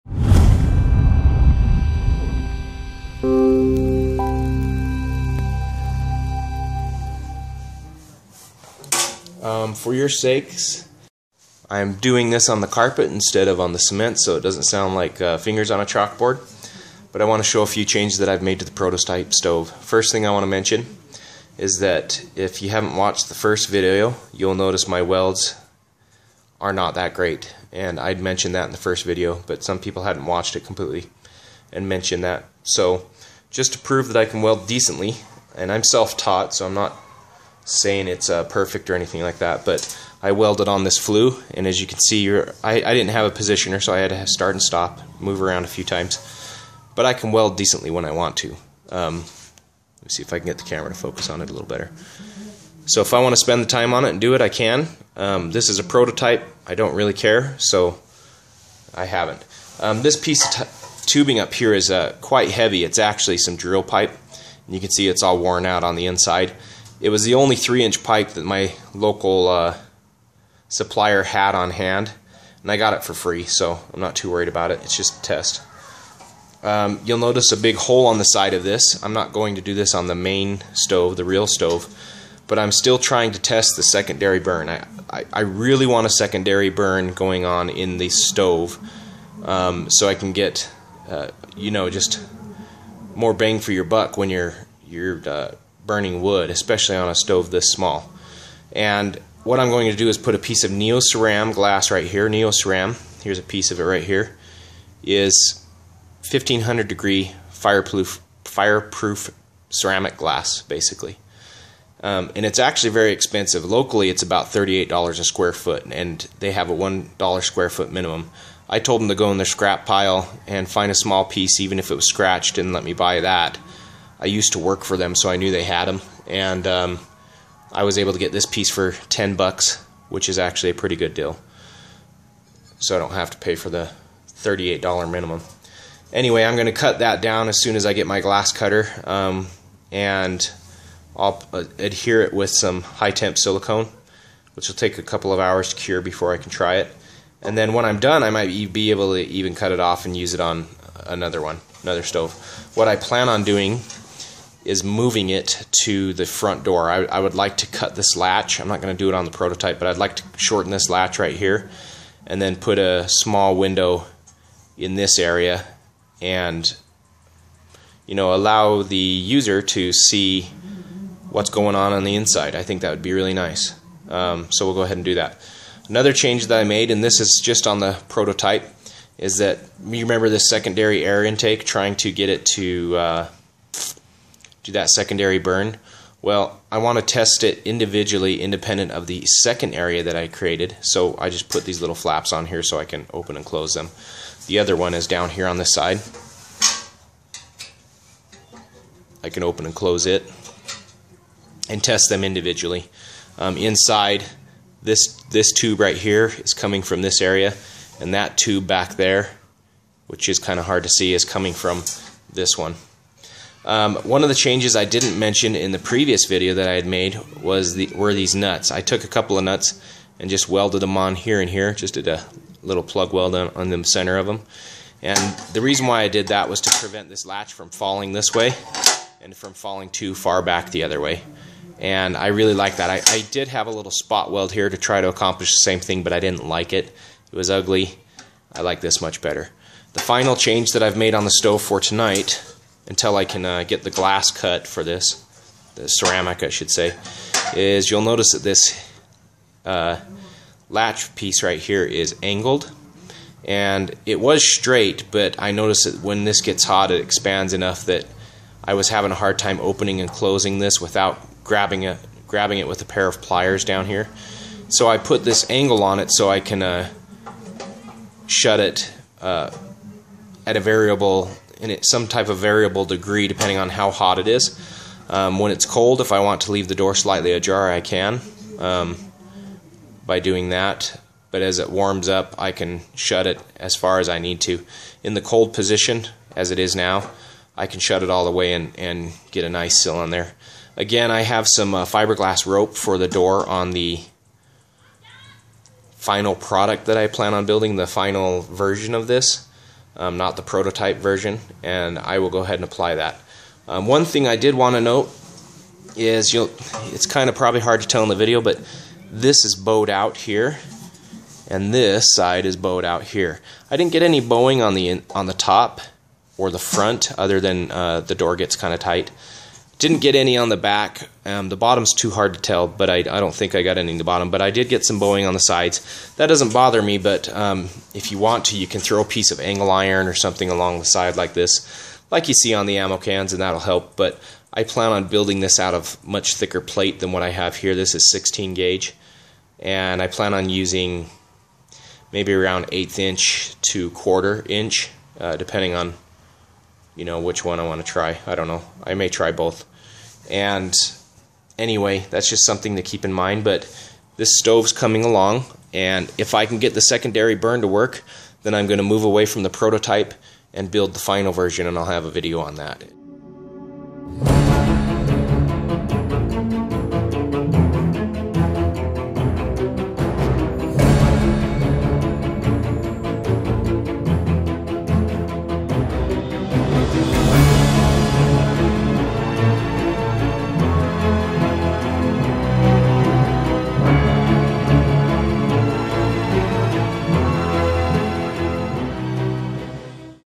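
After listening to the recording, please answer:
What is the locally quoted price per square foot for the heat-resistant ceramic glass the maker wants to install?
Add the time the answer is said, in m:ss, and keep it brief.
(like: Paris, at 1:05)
$38, at 1:54.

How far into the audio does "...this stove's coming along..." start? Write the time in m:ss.
5:54.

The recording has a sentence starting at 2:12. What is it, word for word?
So I don't have to pay for the thirty-eight dollar minimum.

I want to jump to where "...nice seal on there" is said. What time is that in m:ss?
4:49.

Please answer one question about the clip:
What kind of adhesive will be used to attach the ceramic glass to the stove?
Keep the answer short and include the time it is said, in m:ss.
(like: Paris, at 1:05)
High temp silicone, at 2:22.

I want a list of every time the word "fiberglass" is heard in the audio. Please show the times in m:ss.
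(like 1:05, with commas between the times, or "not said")
4:51.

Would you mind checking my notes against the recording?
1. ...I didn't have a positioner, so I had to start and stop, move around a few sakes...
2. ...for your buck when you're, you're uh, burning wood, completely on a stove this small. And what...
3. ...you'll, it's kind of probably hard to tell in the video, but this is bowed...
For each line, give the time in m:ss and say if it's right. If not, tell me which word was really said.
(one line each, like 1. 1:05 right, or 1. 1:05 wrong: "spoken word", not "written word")
1. 0:42 wrong: "times", not "sakes"
2. 1:33 wrong: "especially", not "completely"
3. 5:06 right.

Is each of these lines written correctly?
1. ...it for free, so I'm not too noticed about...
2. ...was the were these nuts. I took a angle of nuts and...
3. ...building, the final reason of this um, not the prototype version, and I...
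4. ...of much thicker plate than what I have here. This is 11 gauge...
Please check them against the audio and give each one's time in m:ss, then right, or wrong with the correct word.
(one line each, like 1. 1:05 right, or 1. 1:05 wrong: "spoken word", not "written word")
1. 1:12 wrong: "worried", not "noticed"
2. 3:37 wrong: "couple", not "angle"
3. 4:57 wrong: "version", not "reason"
4. 5:35 wrong: "16", not "11".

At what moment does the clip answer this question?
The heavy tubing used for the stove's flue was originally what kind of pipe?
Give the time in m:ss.
1:03.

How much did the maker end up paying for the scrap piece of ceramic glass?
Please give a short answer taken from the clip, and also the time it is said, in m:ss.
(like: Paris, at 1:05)
$10, at 2:09.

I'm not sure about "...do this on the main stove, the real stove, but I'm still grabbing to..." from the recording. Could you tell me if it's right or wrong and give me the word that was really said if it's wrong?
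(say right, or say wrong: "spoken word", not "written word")
wrong: "trying", not "grabbing".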